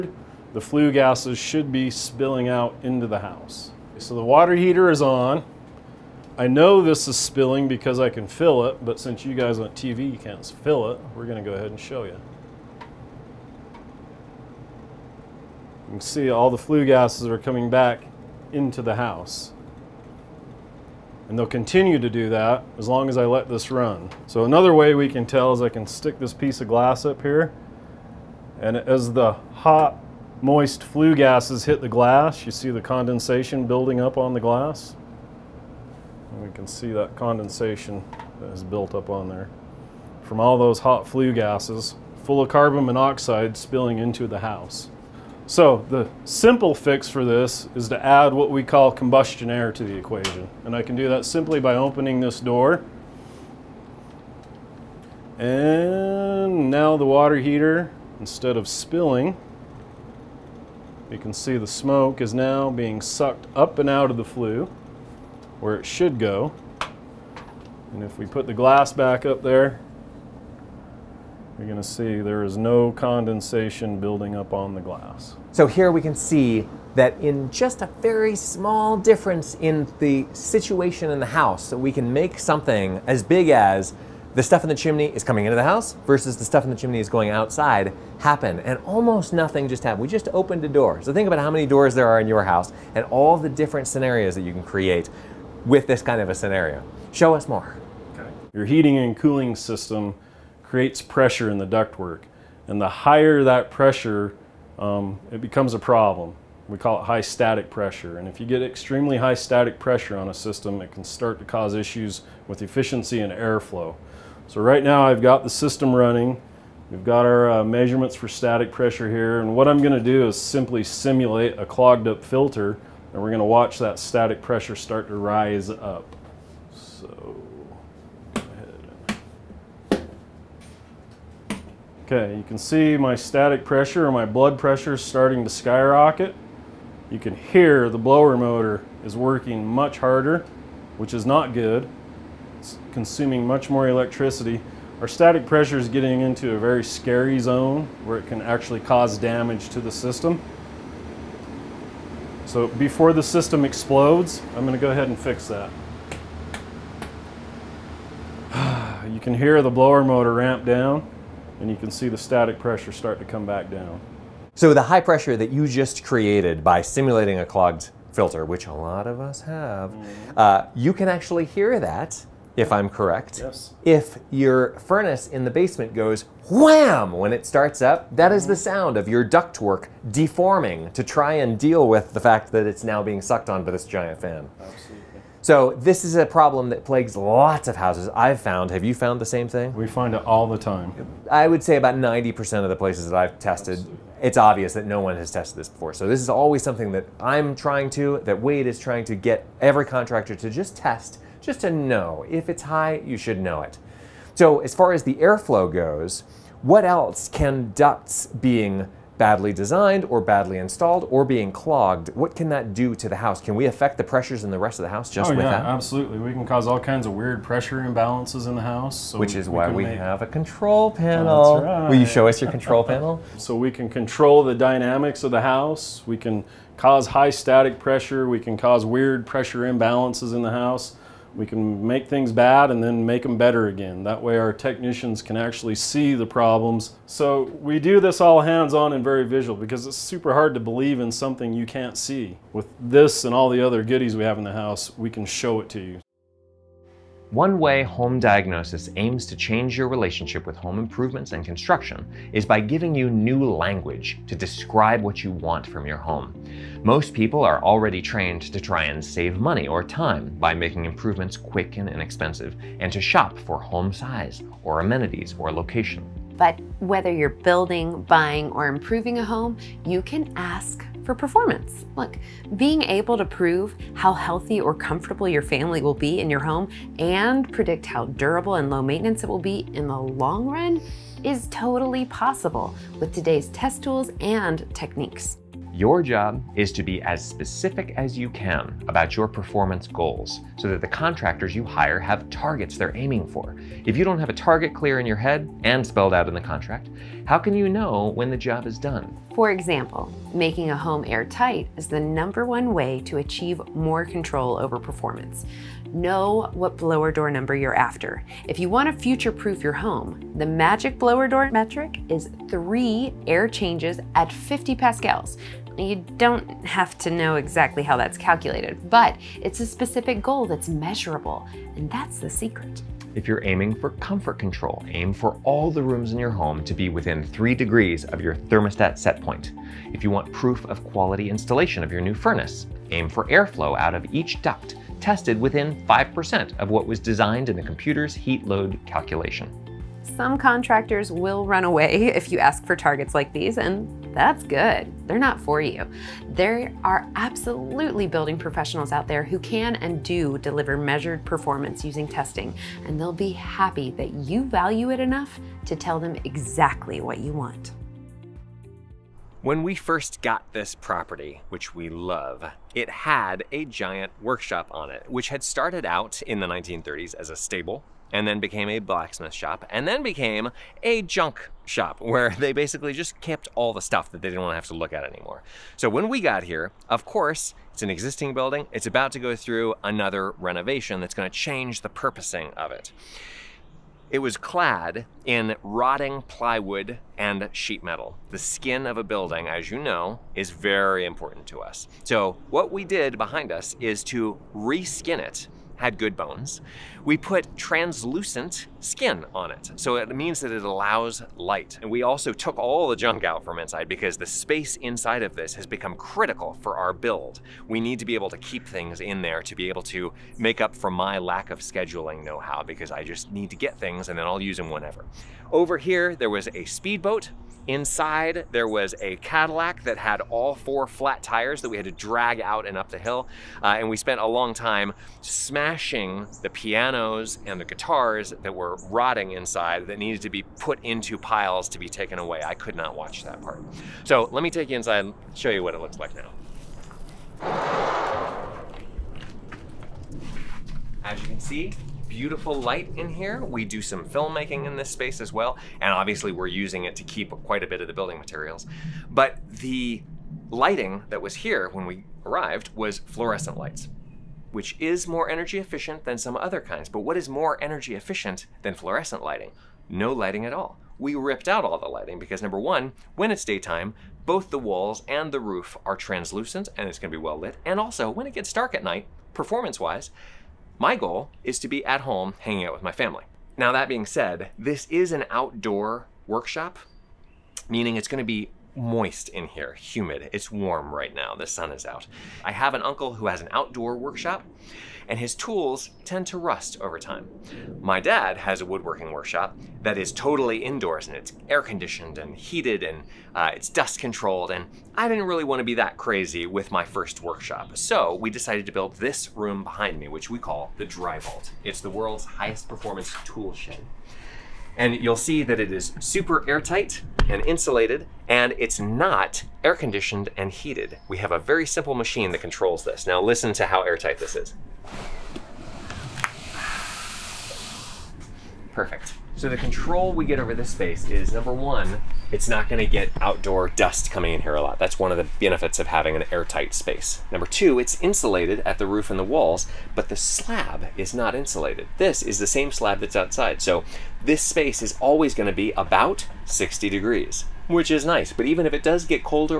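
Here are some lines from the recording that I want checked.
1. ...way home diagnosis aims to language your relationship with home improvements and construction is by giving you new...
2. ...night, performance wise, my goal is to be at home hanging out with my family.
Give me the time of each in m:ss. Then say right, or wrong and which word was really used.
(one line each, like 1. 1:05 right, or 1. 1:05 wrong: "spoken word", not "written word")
1. 4:07 wrong: "change", not "language"
2. 7:48 right.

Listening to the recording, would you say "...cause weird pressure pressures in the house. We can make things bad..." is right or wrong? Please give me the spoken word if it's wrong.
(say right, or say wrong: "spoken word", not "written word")
wrong: "imbalances", not "pressures".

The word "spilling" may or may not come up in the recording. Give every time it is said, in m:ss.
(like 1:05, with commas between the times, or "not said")
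0:01, 0:07, 0:43, 0:58.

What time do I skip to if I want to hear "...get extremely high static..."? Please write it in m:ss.
1:48.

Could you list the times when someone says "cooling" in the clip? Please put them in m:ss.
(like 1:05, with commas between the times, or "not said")
1:39.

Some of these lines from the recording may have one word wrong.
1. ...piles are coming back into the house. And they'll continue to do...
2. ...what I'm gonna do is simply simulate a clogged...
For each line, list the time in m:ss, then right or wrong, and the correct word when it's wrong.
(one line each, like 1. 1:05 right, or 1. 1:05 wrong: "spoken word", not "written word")
1. 0:16 wrong: "gases", not "piles"
2. 1:59 right.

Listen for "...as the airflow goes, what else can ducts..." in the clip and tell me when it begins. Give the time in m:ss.
3:24.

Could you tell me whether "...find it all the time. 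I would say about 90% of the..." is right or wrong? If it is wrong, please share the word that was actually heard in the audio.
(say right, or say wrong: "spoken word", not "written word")
right.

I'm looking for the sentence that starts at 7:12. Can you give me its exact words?
I could not watch that part.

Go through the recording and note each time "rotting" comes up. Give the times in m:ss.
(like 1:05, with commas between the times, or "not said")
6:25, 7:08.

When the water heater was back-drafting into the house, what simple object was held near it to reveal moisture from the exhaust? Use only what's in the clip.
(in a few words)
piece of glass.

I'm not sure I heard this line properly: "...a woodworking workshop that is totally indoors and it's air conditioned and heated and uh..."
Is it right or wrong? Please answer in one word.
right.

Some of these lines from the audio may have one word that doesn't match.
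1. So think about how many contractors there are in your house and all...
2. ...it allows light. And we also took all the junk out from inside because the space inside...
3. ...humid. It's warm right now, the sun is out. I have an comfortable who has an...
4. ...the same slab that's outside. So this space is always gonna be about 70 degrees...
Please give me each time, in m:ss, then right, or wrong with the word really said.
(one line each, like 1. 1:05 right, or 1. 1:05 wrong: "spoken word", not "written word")
1. 1:31 wrong: "doors", not "contractors"
2. 6:40 right
3. 7:59 wrong: "uncle", not "comfortable"
4. 8:52 wrong: "60", not "70".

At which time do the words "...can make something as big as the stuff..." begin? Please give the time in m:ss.
1:21.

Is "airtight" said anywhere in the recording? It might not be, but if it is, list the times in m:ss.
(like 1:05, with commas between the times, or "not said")
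5:01, 8:26, 8:33, 8:46.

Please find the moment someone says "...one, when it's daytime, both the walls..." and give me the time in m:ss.
7:42.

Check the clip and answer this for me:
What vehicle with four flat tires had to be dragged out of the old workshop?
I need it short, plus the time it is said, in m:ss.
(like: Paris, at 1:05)
Cadillac, at 6:59.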